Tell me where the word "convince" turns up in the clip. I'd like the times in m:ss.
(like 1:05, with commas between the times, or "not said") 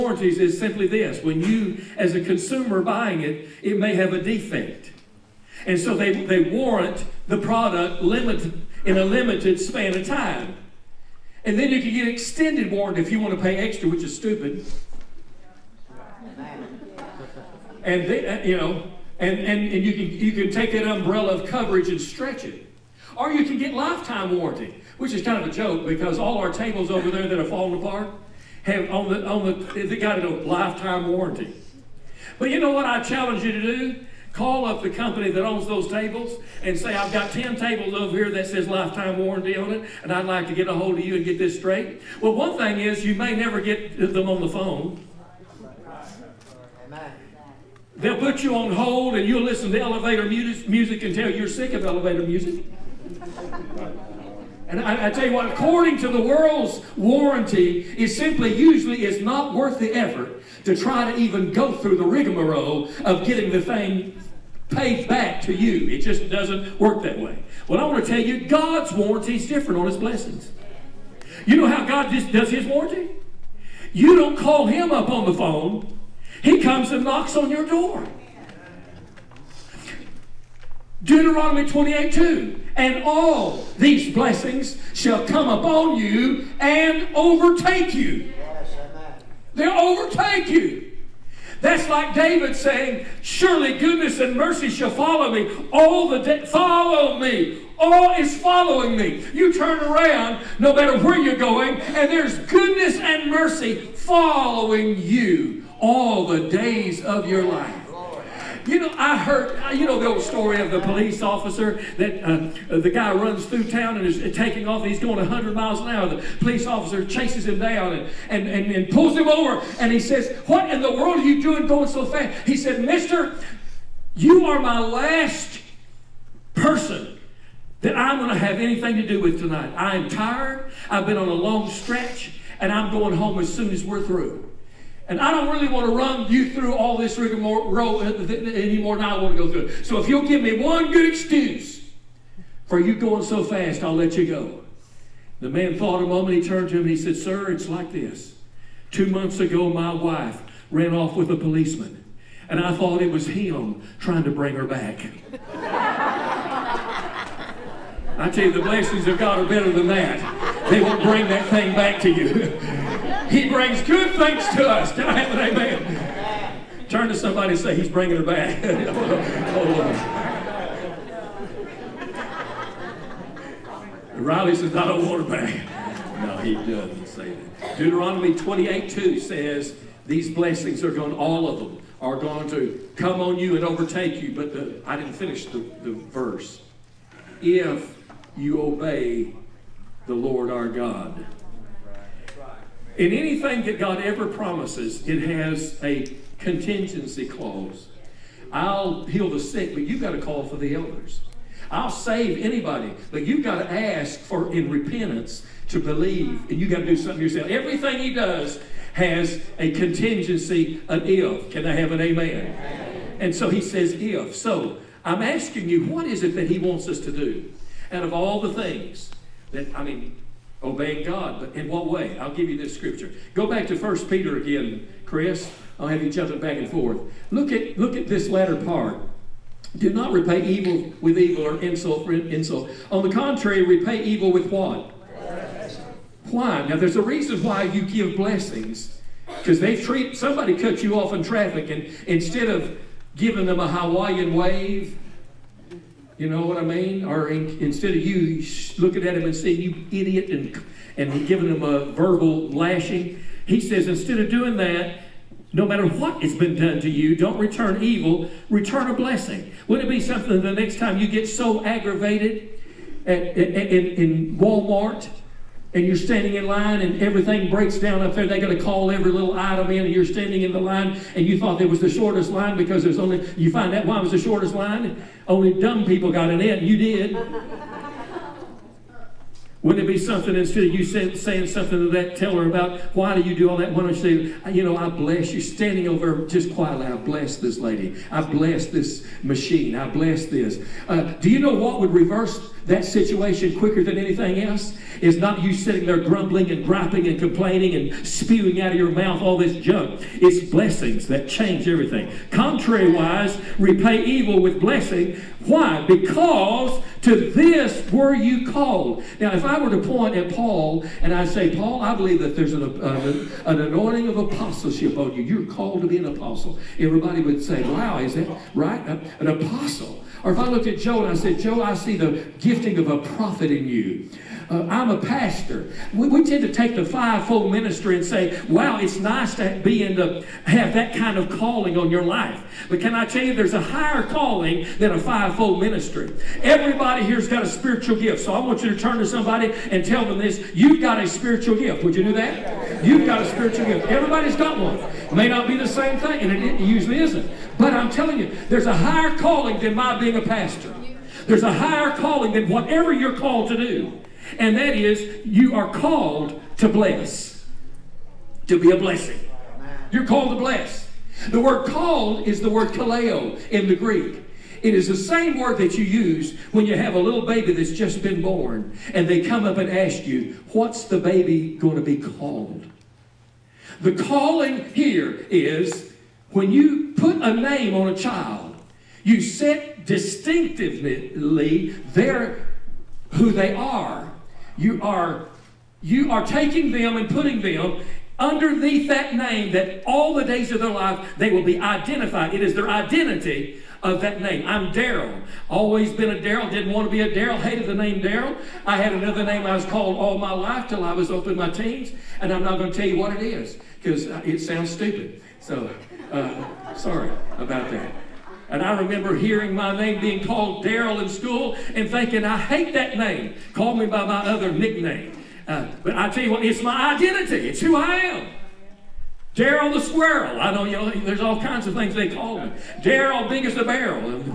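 not said.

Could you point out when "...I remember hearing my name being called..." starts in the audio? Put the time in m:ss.
6:48.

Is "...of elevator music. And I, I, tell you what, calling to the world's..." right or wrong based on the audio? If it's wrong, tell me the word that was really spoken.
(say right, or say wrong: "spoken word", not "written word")
wrong: "according", not "calling".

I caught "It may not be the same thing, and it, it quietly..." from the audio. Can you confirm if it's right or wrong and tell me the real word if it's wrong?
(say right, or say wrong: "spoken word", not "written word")
wrong: "usually", not "quietly".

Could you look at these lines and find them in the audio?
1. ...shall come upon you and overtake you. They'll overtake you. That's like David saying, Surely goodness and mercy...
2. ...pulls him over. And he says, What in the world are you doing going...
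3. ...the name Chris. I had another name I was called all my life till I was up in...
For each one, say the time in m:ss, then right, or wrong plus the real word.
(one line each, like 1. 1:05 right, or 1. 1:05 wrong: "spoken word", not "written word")
1. 1:24 right
2. 1:58 right
3. 6:37 wrong: "Darrel", not "Chris".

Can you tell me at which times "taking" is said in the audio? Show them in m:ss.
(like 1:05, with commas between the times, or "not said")
1:54, 6:26.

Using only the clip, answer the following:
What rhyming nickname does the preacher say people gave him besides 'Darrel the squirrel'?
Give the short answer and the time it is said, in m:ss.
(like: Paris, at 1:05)
Darrel big as a barrel, at 7:02.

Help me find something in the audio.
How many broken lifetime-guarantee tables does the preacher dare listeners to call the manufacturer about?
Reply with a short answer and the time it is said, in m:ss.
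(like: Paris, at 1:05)
10, at 0:37.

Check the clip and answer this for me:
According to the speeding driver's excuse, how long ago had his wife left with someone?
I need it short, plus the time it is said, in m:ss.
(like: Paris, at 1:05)
Two months, at 2:28.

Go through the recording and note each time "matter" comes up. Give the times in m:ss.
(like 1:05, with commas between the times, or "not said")
1:40, 4:15.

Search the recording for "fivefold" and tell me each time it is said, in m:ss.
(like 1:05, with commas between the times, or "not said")
5:26, 5:34.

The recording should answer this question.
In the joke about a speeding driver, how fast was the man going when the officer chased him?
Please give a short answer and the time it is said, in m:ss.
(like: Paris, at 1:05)
100 miles an hour, at 1:55.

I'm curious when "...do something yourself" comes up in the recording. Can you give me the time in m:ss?
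3:26.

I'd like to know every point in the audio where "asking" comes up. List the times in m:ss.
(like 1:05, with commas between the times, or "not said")
3:35.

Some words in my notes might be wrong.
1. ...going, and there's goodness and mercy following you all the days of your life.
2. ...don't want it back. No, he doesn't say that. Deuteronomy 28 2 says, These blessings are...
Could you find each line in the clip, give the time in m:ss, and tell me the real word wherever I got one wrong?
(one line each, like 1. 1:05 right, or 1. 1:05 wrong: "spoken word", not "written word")
1. 1:41 right
2. 2:54 right.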